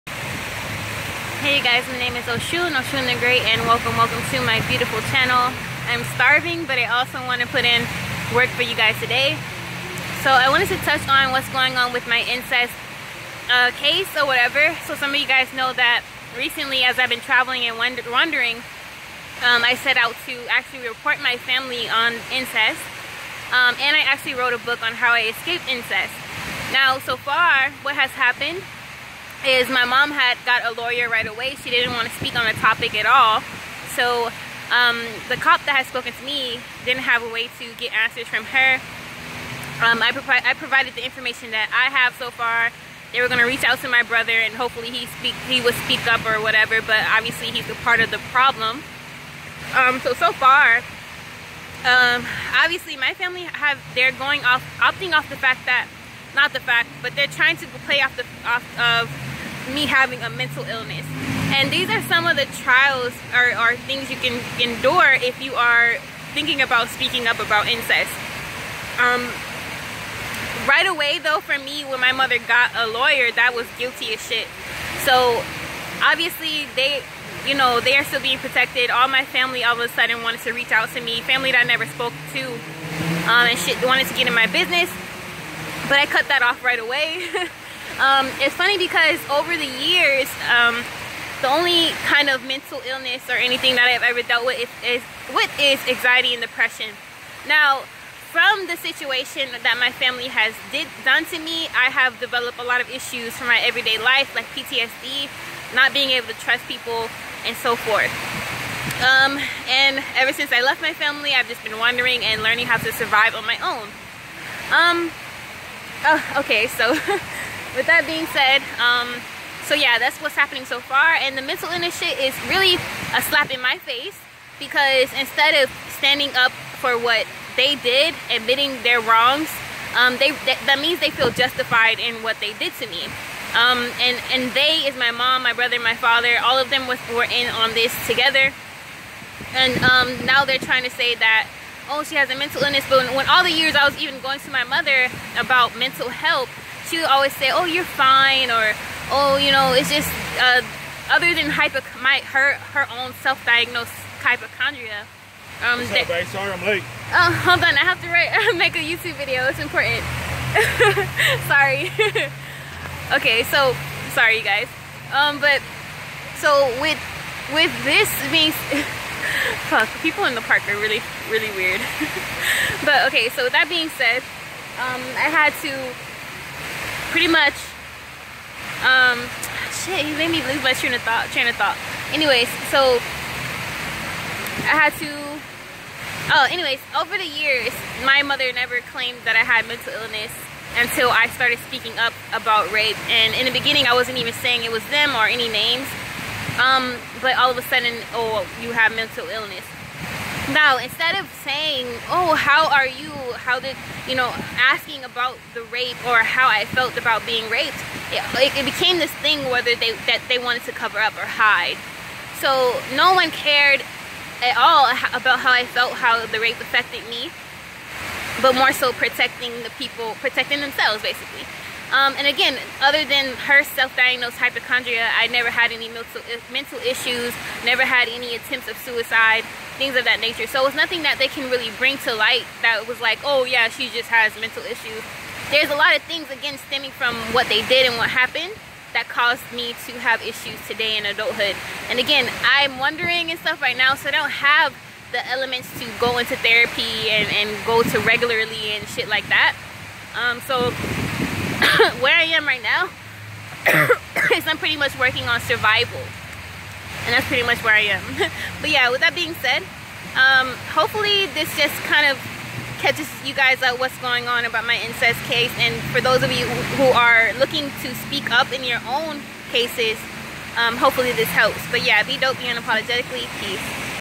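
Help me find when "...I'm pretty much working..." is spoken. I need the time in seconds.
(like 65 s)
254 s.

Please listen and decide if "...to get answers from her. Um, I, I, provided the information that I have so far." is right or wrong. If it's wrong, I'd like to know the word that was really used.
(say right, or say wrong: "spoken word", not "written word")
right.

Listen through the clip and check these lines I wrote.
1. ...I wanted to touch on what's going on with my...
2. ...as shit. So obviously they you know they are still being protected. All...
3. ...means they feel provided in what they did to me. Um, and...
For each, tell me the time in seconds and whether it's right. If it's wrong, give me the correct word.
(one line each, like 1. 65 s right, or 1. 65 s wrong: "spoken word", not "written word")
1. 10 s right
2. 74 s right
3. 130 s wrong: "justified", not "provided".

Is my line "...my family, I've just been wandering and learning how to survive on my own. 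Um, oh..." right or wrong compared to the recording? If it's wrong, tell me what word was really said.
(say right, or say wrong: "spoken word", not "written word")
right.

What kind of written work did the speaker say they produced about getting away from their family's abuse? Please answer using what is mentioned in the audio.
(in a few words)
A book.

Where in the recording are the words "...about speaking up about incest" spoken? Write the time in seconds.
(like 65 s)
66 s.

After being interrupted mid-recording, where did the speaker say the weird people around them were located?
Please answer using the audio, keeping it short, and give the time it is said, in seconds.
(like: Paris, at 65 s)
The park, at 170 s.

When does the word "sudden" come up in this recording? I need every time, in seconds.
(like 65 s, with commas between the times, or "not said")
79 s, 197 s.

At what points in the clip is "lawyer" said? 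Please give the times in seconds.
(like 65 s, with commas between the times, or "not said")
30 s, 72 s.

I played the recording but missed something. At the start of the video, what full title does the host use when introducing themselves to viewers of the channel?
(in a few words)
Oshun the Great.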